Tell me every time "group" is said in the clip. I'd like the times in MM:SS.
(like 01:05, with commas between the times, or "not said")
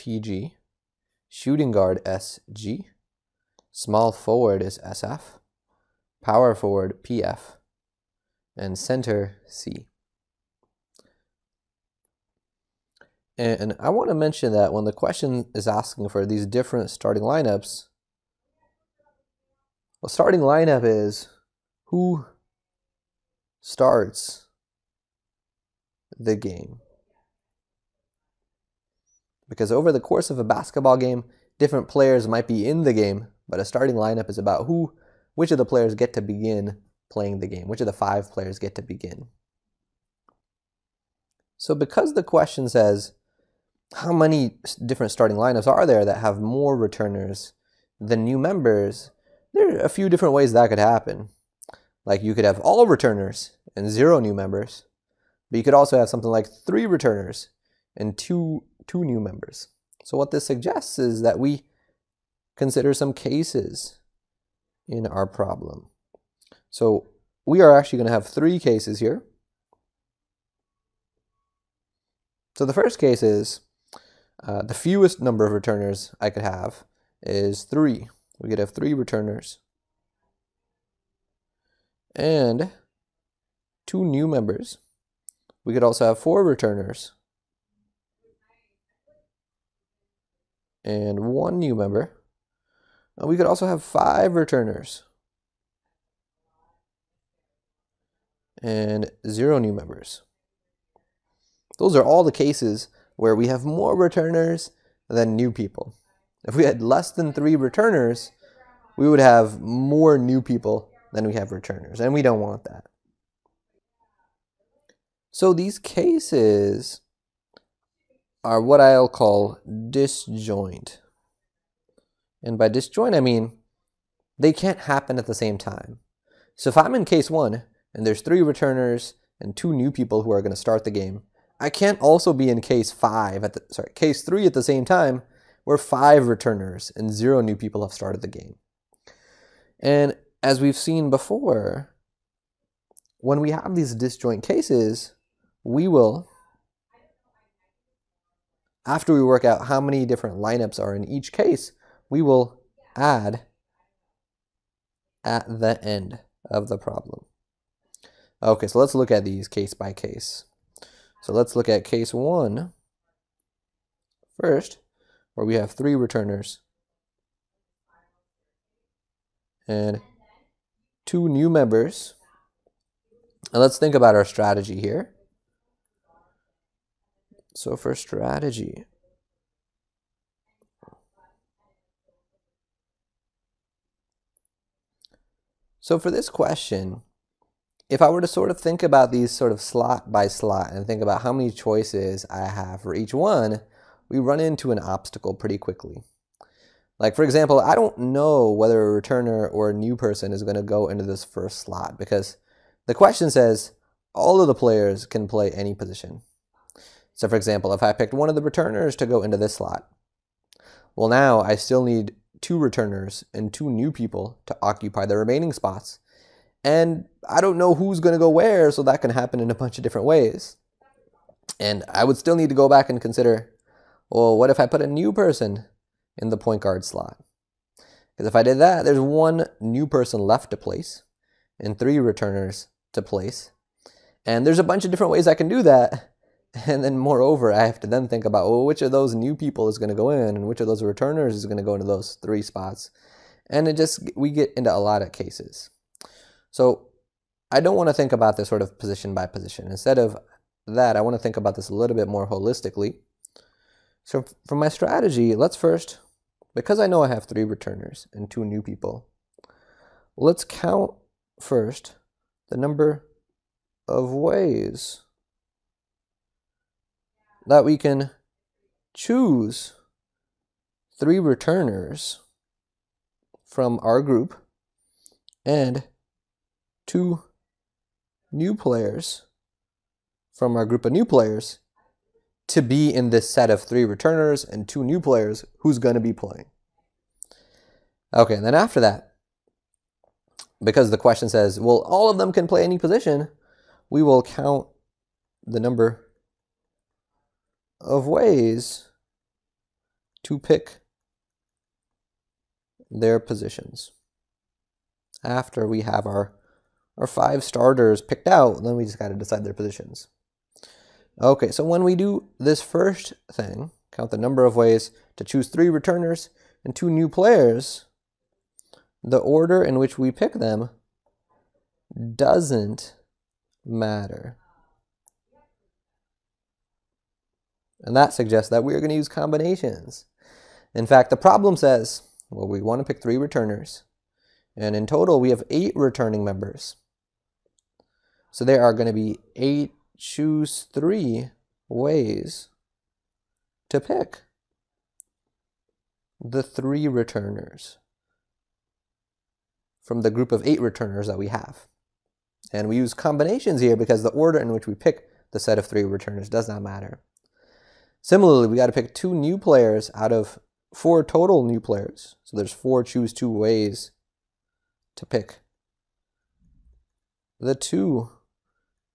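04:34, 04:40, 05:50.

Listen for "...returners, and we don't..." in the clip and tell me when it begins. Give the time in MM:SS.
01:51.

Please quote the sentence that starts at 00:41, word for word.
So because the question says, how many different starting lineups are there that have more returners than new members?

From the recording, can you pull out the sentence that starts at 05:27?
And that suggests that we are going to use combinations.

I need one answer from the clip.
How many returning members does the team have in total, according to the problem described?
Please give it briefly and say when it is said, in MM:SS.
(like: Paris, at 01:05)
8, at 05:35.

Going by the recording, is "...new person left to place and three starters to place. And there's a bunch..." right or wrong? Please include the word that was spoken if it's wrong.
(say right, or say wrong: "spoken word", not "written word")
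wrong: "returners", not "starters".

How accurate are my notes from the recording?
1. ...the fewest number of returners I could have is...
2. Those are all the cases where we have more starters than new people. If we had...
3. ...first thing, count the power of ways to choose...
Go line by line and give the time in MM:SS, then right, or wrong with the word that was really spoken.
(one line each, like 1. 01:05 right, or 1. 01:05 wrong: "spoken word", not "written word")
1. 01:14 right
2. 01:41 wrong: "returners", not "starters"
3. 05:12 wrong: "number", not "power".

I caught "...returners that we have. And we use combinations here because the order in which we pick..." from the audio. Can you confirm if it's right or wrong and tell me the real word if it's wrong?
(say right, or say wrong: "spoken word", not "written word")
right.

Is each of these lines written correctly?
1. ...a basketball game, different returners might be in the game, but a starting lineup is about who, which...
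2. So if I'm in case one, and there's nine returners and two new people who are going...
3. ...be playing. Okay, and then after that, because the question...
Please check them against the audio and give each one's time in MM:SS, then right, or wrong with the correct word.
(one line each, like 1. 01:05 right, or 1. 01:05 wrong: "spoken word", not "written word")
1. 00:30 wrong: "players", not "returners"
2. 02:06 wrong: "three", not "nine"
3. 04:46 right.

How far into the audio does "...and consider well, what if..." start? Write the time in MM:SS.
03:42.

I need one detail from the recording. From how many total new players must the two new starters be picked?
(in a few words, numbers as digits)
4.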